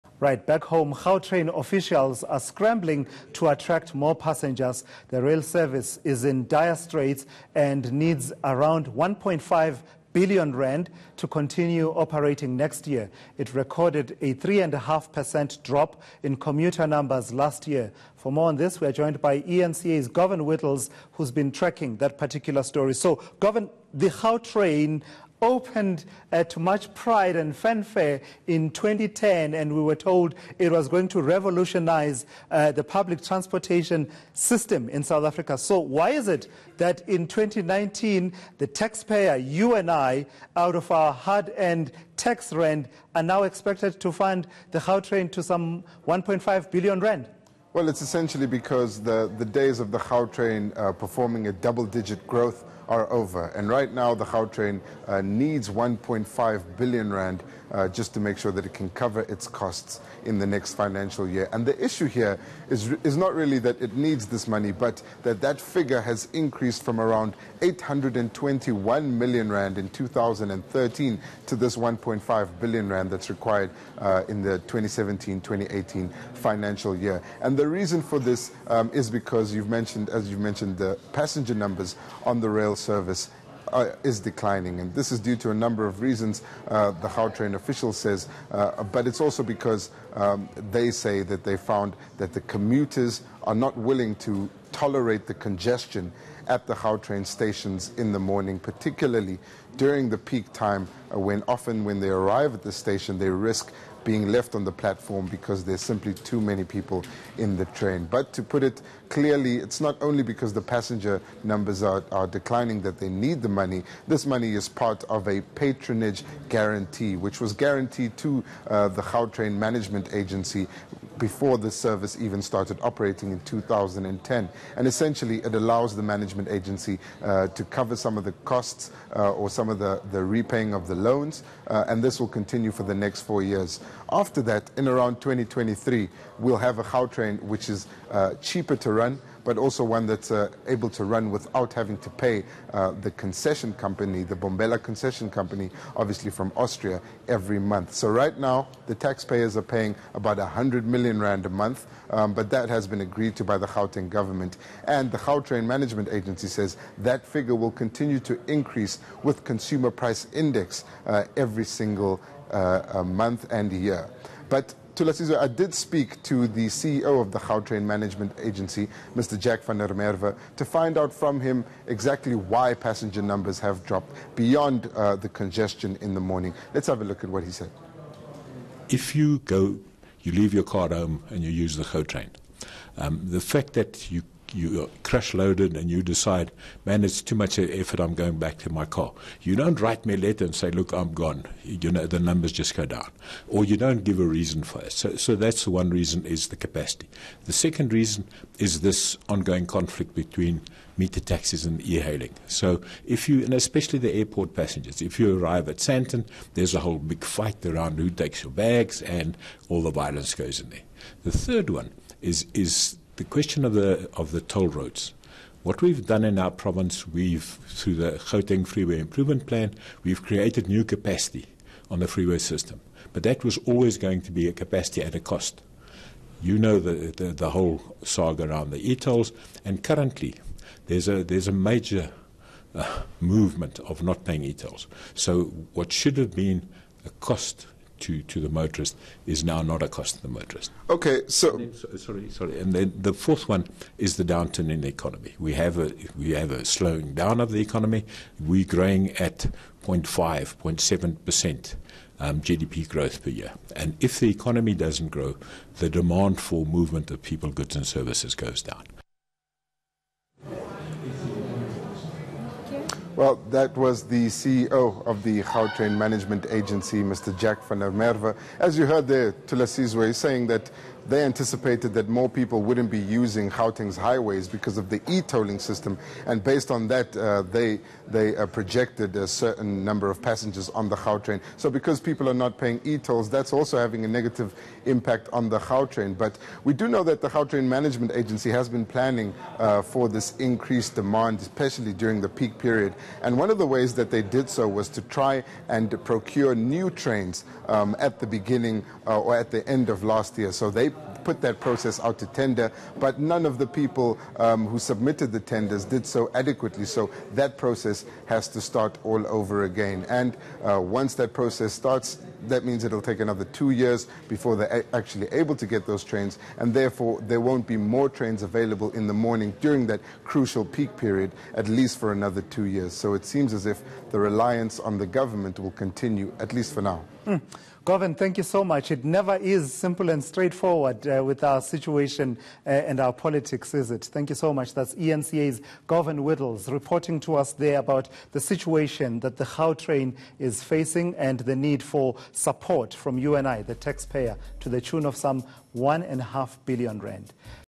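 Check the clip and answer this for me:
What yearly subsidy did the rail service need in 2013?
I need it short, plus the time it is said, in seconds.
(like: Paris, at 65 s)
821 million rand, at 67 s.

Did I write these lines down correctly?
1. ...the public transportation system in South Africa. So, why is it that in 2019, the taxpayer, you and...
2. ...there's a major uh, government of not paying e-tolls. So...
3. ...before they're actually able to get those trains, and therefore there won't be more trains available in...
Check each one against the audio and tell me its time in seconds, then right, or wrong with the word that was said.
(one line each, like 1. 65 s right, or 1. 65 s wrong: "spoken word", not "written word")
1. 32 s right
2. 231 s wrong: "movement", not "government"
3. 314 s right.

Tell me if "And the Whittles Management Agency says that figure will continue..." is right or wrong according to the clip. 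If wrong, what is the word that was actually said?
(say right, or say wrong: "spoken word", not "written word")
wrong: "Gautrain", not "Whittles".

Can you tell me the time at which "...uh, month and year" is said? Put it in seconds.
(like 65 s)
162 s.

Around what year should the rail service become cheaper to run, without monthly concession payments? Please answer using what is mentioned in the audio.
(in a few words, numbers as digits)
2023.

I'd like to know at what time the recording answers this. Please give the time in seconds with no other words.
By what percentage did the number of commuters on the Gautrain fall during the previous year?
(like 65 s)
14 s.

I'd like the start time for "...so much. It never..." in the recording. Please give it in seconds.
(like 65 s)
328 s.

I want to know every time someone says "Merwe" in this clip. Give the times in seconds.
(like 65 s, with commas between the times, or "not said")
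169 s, 267 s.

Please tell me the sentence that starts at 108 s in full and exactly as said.
But to put it clearly, it's not only because the passenger numbers are, are declining that they need the money.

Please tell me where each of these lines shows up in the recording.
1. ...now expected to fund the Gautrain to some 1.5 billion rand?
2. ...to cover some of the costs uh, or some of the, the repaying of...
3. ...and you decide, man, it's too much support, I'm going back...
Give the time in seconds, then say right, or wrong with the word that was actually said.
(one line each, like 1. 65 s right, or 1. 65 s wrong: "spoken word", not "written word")
1. 43 s right
2. 127 s right
3. 185 s wrong: "effort", not "support".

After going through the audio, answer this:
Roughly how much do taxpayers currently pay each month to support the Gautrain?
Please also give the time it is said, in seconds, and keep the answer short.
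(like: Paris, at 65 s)
100 million rand, at 150 s.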